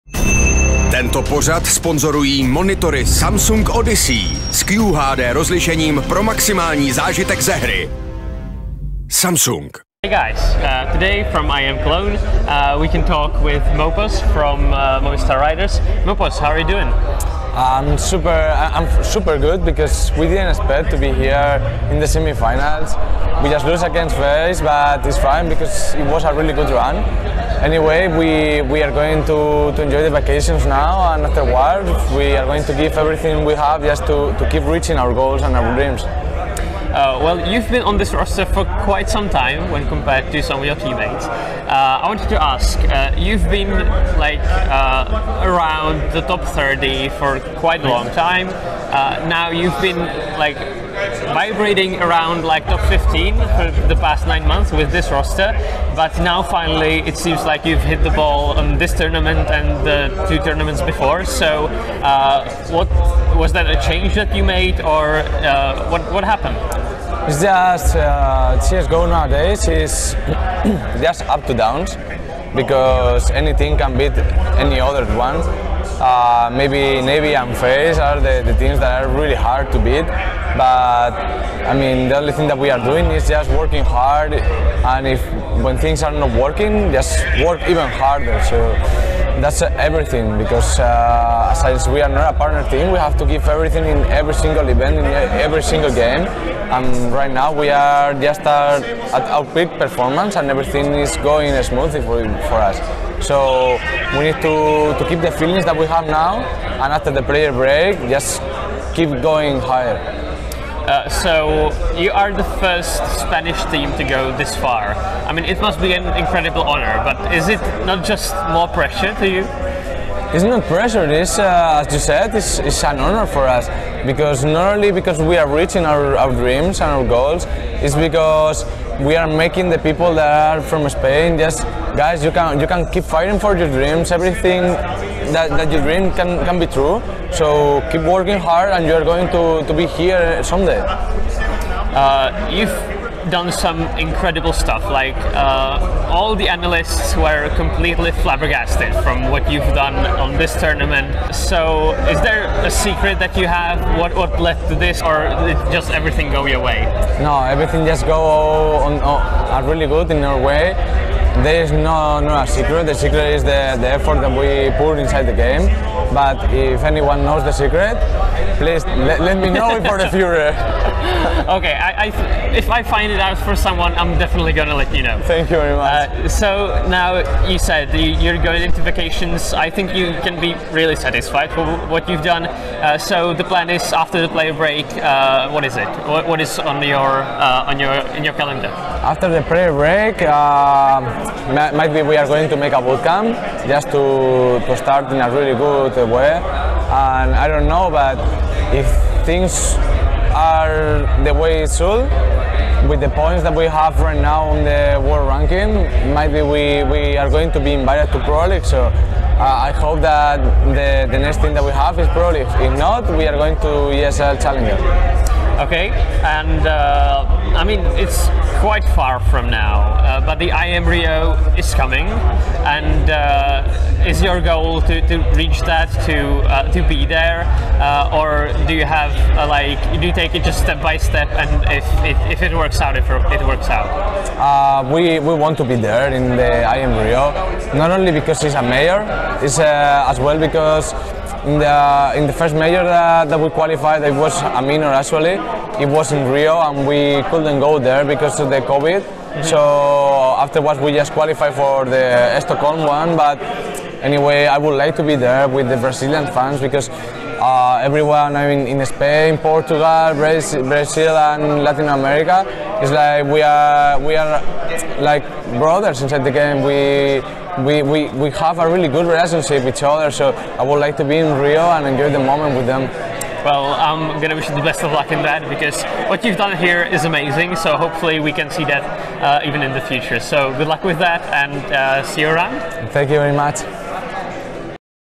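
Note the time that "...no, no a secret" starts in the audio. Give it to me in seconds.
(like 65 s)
161 s.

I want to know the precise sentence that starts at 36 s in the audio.
Uh, well, you've been on this roster for quite some time when compared to some of your teammates.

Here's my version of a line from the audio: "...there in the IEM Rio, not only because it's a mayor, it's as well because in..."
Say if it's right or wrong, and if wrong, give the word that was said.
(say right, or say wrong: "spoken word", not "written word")
right.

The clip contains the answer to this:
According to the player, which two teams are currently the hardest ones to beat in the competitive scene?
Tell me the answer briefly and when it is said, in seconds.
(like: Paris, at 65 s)
Navy and Face, at 77 s.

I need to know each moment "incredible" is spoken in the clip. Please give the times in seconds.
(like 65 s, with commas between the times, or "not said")
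116 s, 143 s.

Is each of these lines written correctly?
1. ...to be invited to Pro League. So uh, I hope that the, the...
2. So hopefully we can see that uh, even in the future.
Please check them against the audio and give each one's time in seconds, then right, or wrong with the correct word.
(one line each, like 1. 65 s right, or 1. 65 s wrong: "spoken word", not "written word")
1. 207 s right
2. 277 s right.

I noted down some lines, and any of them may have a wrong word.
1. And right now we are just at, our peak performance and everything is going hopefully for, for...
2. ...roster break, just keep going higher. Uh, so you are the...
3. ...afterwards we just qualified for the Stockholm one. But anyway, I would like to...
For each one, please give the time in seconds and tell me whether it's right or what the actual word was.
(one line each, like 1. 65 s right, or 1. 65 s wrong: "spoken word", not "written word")
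1. 96 s wrong: "smoothly", not "hopefully"
2. 107 s wrong: "player", not "roster"
3. 250 s right.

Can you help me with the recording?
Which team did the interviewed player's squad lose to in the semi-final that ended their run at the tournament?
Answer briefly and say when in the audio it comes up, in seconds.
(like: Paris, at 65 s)
Veris, at 24 s.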